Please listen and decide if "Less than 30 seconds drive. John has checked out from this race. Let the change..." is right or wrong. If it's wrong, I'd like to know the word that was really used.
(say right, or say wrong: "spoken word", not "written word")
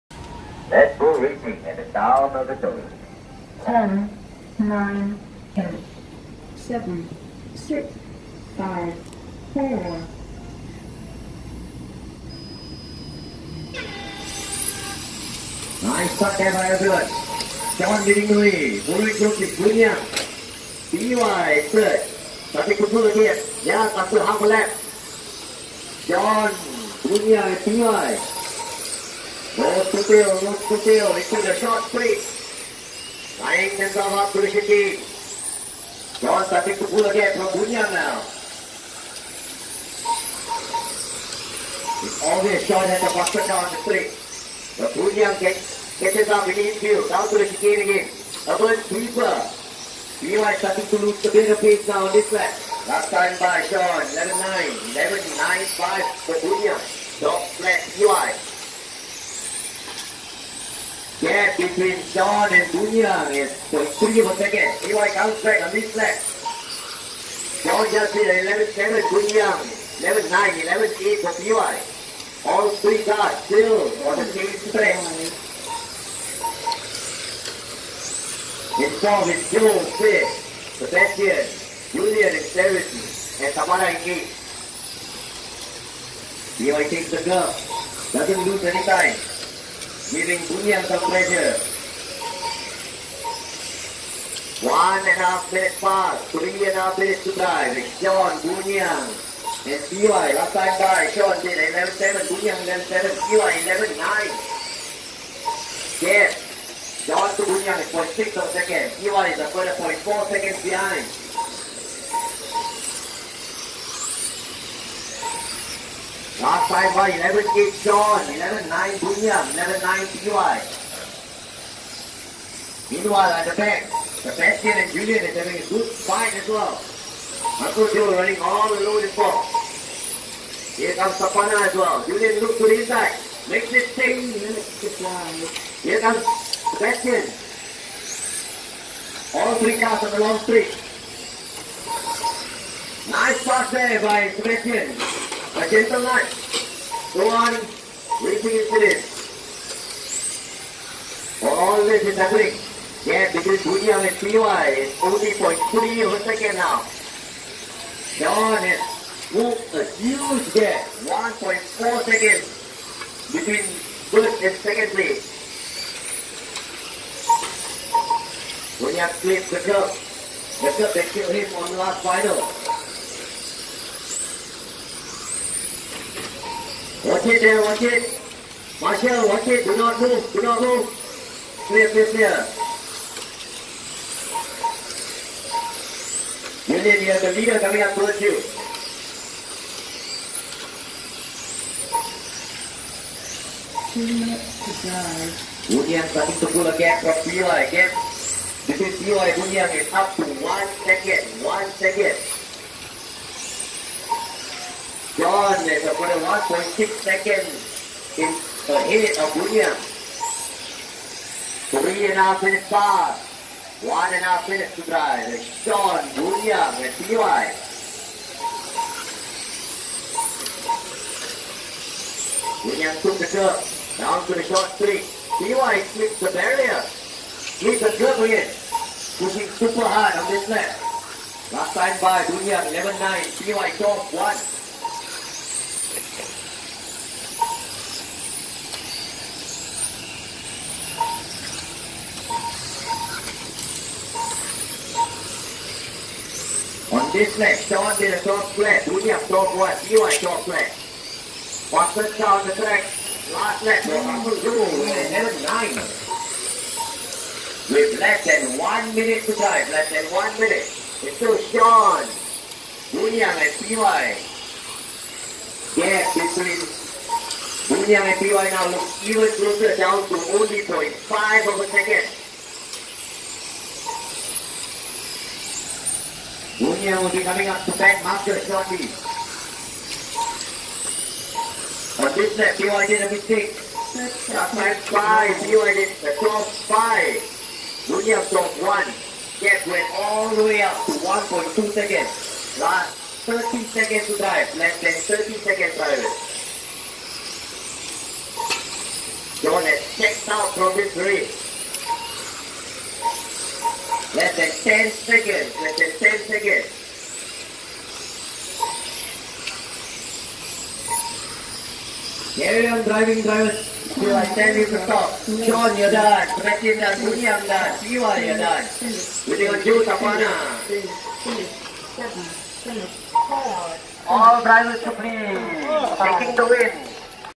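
right.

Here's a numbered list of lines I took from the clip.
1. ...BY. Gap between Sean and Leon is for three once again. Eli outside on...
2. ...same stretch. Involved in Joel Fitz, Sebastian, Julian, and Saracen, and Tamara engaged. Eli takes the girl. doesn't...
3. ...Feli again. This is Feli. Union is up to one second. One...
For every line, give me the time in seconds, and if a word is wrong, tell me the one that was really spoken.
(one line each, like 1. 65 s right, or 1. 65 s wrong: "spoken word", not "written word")
1. 57 s right
2. 74 s right
3. 197 s right.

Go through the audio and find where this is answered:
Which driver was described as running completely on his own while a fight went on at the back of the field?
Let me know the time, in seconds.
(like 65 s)
127 s.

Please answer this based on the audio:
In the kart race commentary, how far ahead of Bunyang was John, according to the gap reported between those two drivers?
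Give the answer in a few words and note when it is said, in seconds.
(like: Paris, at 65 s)
0.6 seconds, at 107 s.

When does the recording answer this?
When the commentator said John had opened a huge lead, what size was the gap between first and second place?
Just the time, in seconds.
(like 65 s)
161 s.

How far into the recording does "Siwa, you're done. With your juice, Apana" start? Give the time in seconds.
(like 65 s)
317 s.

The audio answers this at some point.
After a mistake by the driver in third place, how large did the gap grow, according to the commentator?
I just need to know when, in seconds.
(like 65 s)
290 s.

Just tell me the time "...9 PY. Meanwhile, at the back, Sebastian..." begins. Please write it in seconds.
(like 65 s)
119 s.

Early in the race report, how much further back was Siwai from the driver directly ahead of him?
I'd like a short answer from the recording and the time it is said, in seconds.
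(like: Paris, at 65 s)
0.4 seconds, at 109 s.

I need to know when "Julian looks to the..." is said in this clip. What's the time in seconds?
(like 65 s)
132 s.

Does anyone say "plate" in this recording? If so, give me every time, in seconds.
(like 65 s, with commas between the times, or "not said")
43 s.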